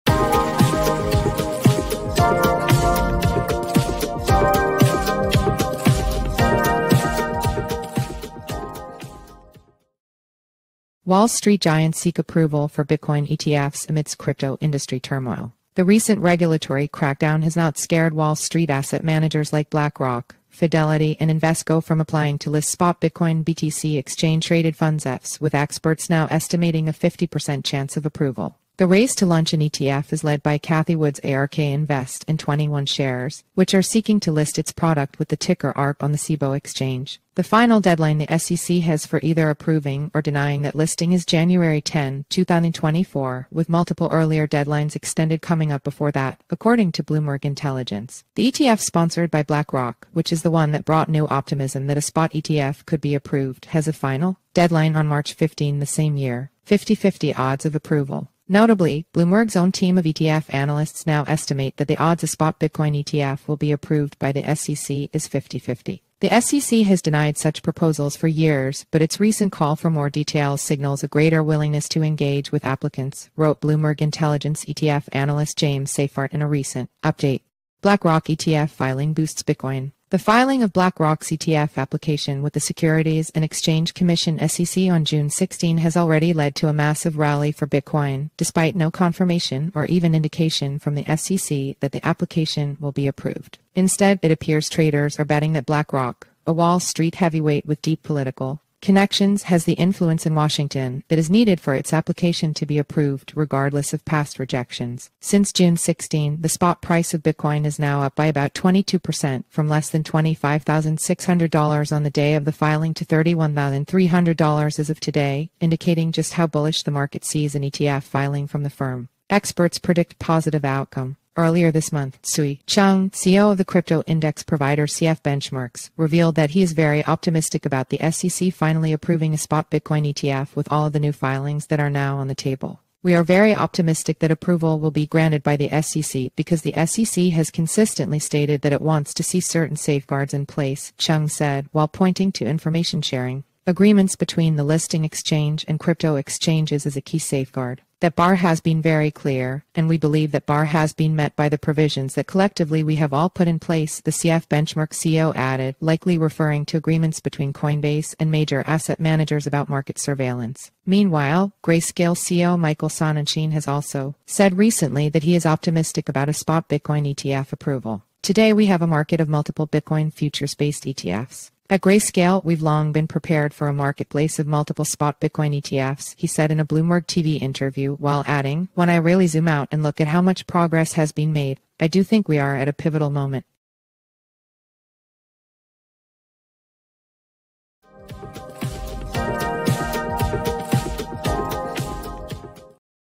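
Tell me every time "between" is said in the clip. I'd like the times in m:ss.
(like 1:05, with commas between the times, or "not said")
2:24, 2:37.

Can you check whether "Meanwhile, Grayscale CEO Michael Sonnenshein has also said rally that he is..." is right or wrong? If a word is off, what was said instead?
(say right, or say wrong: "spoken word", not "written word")
wrong: "recently", not "rally".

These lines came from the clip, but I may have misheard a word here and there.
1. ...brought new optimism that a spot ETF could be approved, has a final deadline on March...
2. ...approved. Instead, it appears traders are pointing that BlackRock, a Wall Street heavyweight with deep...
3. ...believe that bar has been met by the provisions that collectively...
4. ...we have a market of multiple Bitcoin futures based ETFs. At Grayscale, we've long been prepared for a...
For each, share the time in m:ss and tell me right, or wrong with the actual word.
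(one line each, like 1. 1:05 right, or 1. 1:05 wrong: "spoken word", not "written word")
1. 0:50 right
2. 1:33 wrong: "betting", not "pointing"
3. 2:29 right
4. 2:48 right.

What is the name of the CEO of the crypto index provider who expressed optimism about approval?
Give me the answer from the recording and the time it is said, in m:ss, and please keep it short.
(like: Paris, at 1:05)
Sui Chung, at 2:02.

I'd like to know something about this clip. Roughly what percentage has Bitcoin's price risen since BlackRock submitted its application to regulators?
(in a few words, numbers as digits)
22%.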